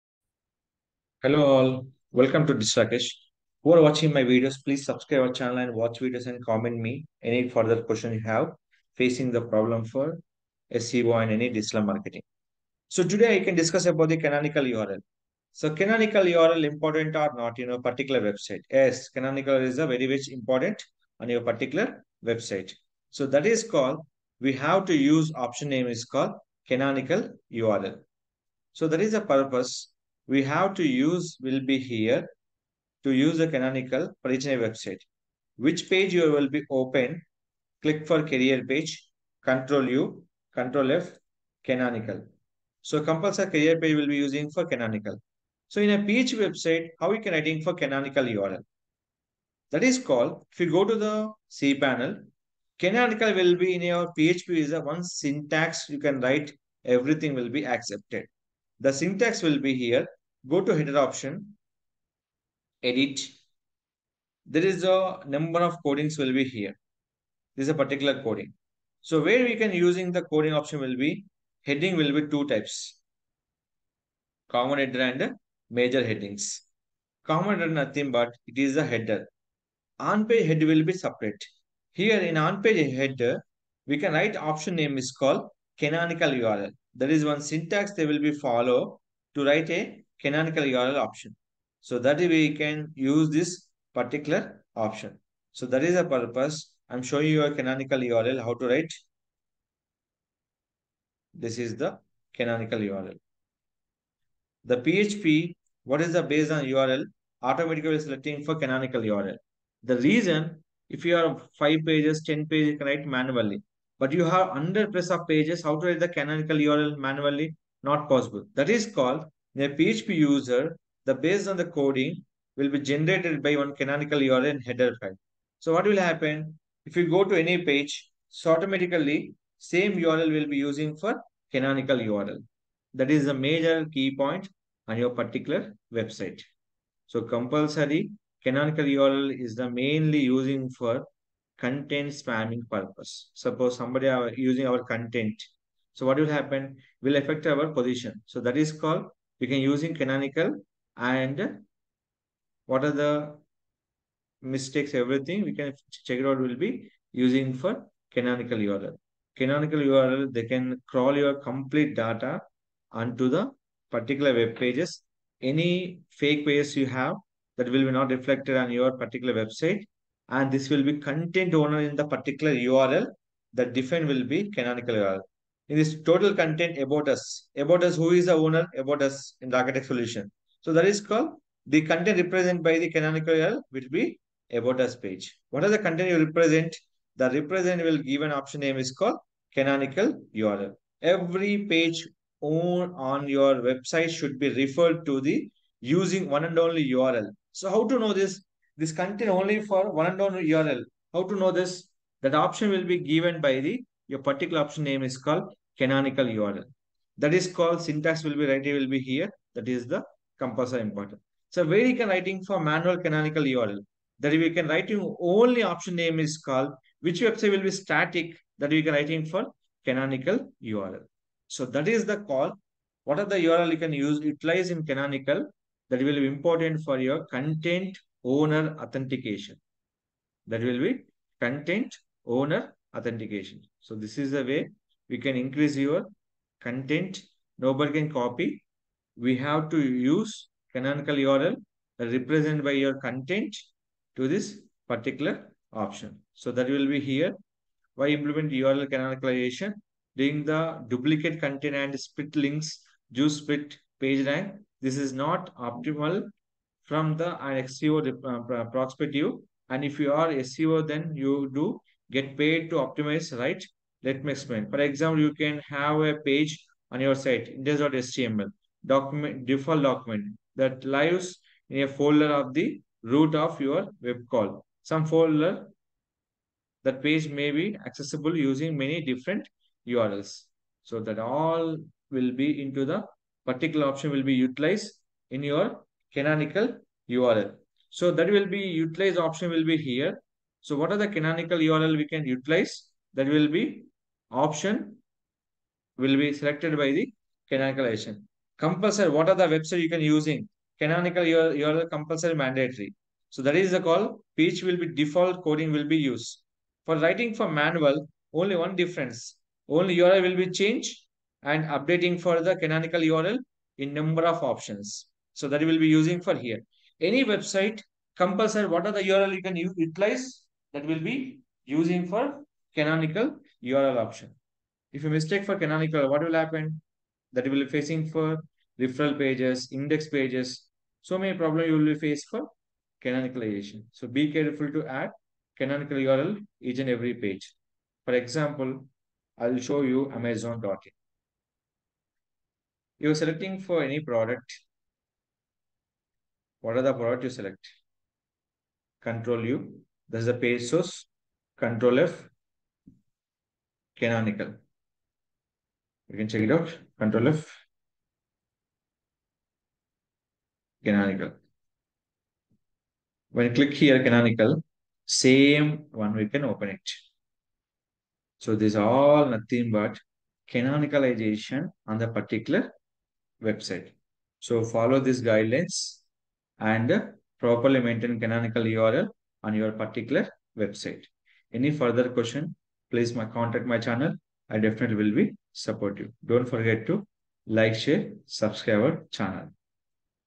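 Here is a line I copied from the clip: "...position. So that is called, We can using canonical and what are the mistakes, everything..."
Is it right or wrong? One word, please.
right.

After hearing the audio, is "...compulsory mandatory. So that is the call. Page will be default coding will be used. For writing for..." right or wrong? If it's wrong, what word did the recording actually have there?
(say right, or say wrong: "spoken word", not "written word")
right.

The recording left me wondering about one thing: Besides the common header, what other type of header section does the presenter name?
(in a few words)
major headings.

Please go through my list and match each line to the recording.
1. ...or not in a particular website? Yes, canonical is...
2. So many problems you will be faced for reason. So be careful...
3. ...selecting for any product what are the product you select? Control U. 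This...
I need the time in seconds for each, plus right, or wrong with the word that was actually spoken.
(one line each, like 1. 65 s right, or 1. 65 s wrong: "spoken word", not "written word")
1. 17 s right
2. 331 s wrong: "canonicalization", not "reason"
3. 343 s right.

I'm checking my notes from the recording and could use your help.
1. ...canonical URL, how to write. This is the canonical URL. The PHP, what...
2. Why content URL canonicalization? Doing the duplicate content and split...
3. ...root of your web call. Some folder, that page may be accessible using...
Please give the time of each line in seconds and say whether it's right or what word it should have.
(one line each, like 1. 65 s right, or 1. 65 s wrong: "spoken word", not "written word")
1. 97 s right
2. 247 s wrong: "implement", not "content"
3. 273 s right.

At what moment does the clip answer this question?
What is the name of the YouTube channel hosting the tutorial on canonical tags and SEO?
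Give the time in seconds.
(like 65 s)
2 s.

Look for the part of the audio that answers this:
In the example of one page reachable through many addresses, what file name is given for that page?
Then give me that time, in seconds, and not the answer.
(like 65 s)
267 s.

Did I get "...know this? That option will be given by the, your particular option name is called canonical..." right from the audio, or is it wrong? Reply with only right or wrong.
right.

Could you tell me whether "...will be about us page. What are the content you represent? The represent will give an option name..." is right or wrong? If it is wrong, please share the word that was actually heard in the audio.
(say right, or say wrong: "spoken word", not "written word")
right.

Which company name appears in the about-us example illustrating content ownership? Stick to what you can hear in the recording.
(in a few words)
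Rakesh Tech Solution.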